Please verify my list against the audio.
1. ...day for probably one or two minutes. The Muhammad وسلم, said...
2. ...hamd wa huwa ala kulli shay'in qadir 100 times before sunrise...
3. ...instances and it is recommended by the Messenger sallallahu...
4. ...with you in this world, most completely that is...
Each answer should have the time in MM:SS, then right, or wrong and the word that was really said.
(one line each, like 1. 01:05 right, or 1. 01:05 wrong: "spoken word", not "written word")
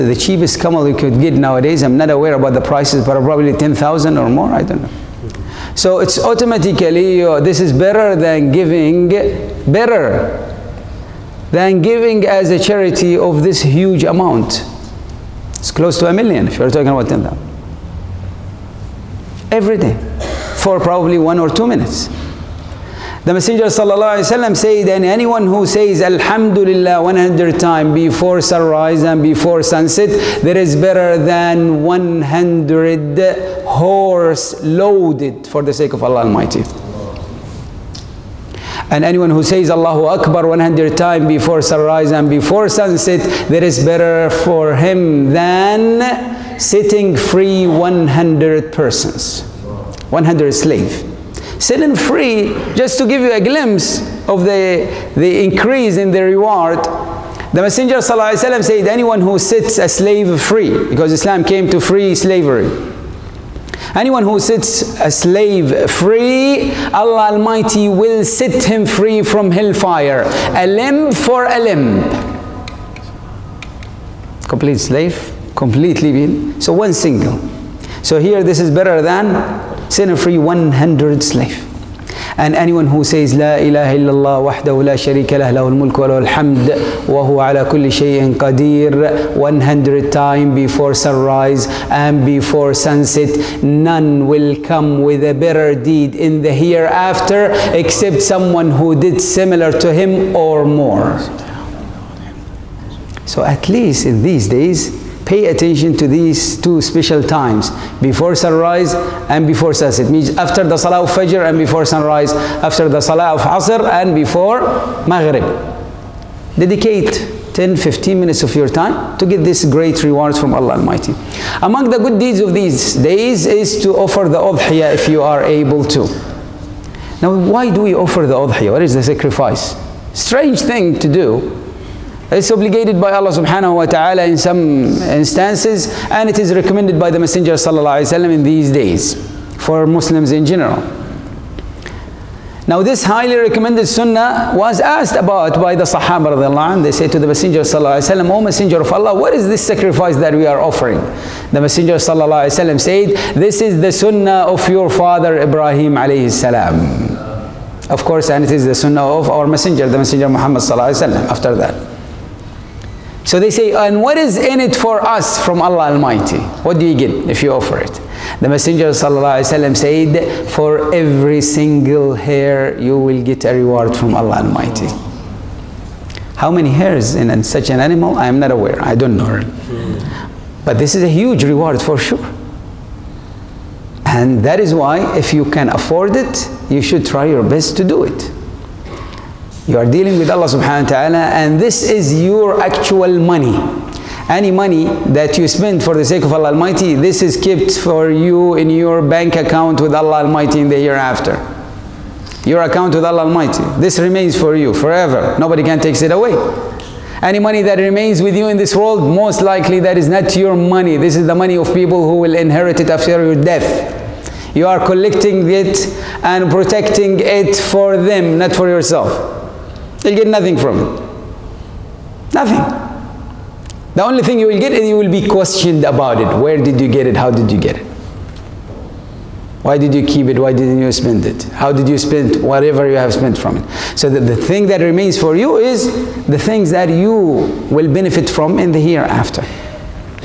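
1. 00:19 wrong: "Messenger", not "Muhammad"
2. 01:26 right
3. 02:15 right
4. 03:28 wrong: "likely", not "completely".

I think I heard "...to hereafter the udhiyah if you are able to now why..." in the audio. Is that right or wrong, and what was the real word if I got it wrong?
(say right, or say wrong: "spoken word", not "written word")
wrong: "offer", not "hereafter".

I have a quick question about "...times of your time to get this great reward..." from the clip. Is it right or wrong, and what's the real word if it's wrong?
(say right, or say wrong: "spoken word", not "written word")
wrong: "minutes", not "times".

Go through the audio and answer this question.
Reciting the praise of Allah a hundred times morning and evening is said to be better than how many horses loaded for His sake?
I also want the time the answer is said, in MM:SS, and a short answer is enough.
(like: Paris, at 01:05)
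100, at 00:31.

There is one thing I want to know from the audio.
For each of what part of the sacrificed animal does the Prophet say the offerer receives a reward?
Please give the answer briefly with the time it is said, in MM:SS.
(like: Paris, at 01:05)
every single hair, at 02:50.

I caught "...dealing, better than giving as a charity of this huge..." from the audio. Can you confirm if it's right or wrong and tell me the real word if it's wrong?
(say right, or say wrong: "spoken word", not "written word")
wrong: "giving", not "dealing".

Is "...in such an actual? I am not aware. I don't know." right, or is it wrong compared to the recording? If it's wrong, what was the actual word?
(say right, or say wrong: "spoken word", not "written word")
wrong: "animal", not "actual".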